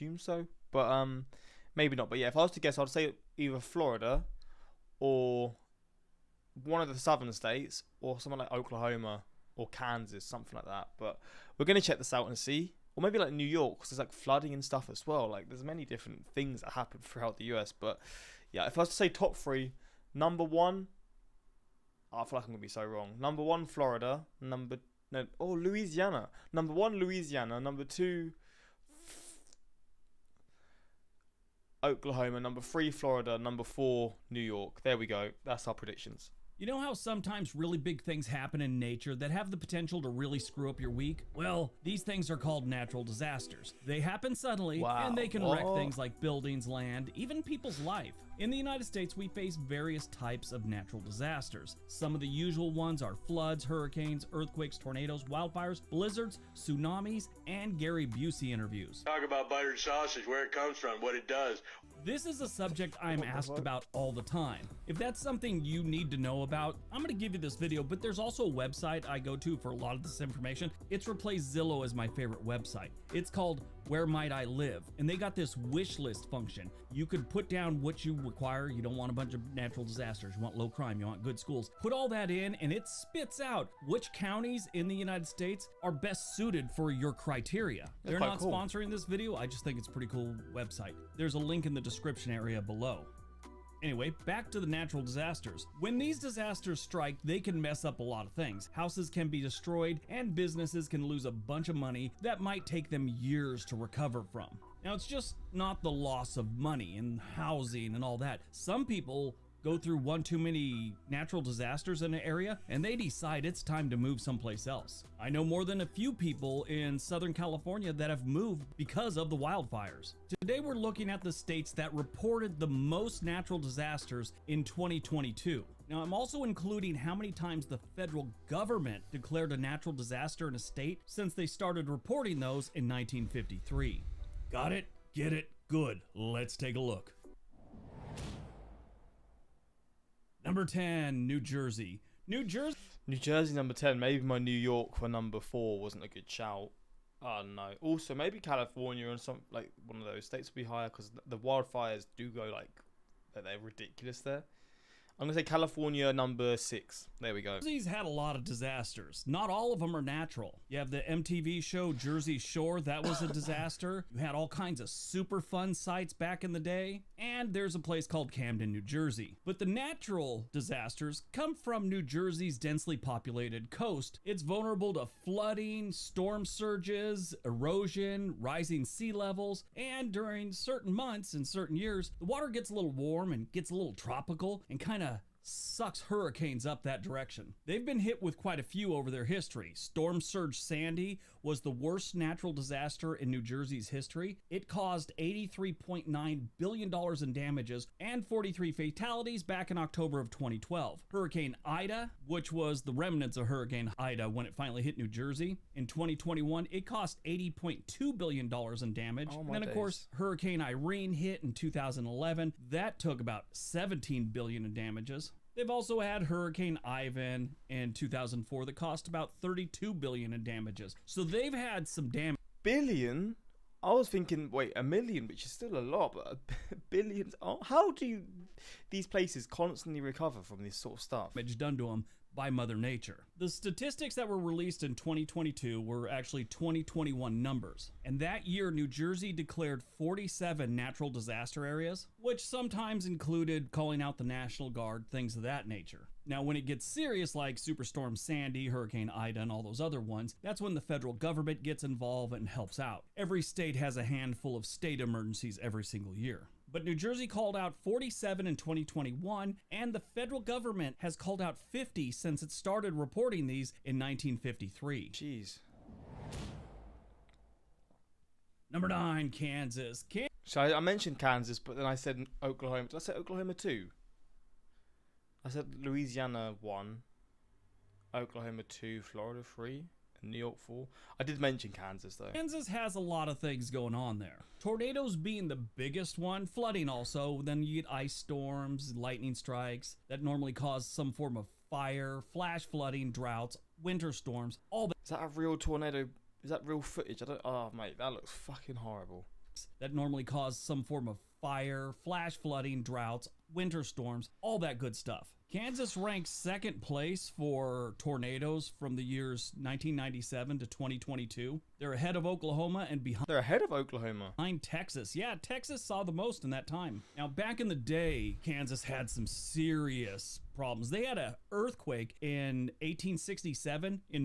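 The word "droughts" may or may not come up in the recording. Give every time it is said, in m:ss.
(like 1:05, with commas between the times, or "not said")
4:53, 5:02.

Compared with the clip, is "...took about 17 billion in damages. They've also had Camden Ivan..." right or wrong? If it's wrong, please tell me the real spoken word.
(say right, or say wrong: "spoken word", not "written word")
wrong: "Hurricane", not "Camden".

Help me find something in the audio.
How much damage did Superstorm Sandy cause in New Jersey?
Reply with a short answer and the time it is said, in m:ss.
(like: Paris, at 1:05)
$83.9 billion, at 3:15.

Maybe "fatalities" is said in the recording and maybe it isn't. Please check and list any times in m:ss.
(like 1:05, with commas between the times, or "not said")
3:18.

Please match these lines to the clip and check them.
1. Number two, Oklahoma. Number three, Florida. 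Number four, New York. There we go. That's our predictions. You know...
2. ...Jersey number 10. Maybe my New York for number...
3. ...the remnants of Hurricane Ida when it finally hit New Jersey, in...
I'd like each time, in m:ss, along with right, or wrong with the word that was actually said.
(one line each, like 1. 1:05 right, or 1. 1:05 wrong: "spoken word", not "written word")
1. 0:27 right
2. 2:23 right
3. 3:22 right.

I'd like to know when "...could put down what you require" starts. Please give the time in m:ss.
1:17.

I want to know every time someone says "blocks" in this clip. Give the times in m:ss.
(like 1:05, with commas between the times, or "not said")
not said.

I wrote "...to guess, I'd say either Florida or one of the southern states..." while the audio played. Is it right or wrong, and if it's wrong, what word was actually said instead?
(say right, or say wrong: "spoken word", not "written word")
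right.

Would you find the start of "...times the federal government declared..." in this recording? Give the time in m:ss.
2:07.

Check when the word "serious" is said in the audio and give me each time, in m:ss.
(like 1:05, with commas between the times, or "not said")
4:06, 5:19.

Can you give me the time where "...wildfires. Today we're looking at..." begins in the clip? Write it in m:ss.
1:59.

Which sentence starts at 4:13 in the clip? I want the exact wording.
Every state has a handful of state emergencies every single year.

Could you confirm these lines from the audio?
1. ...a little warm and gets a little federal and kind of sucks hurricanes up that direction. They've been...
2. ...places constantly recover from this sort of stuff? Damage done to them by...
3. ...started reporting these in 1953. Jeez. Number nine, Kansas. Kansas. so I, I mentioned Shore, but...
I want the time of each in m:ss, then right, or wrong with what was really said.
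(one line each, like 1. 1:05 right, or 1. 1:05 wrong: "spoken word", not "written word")
1. 3:02 wrong: "tropical", not "federal"
2. 3:49 right
3. 4:22 wrong: "Kansas", not "Shore".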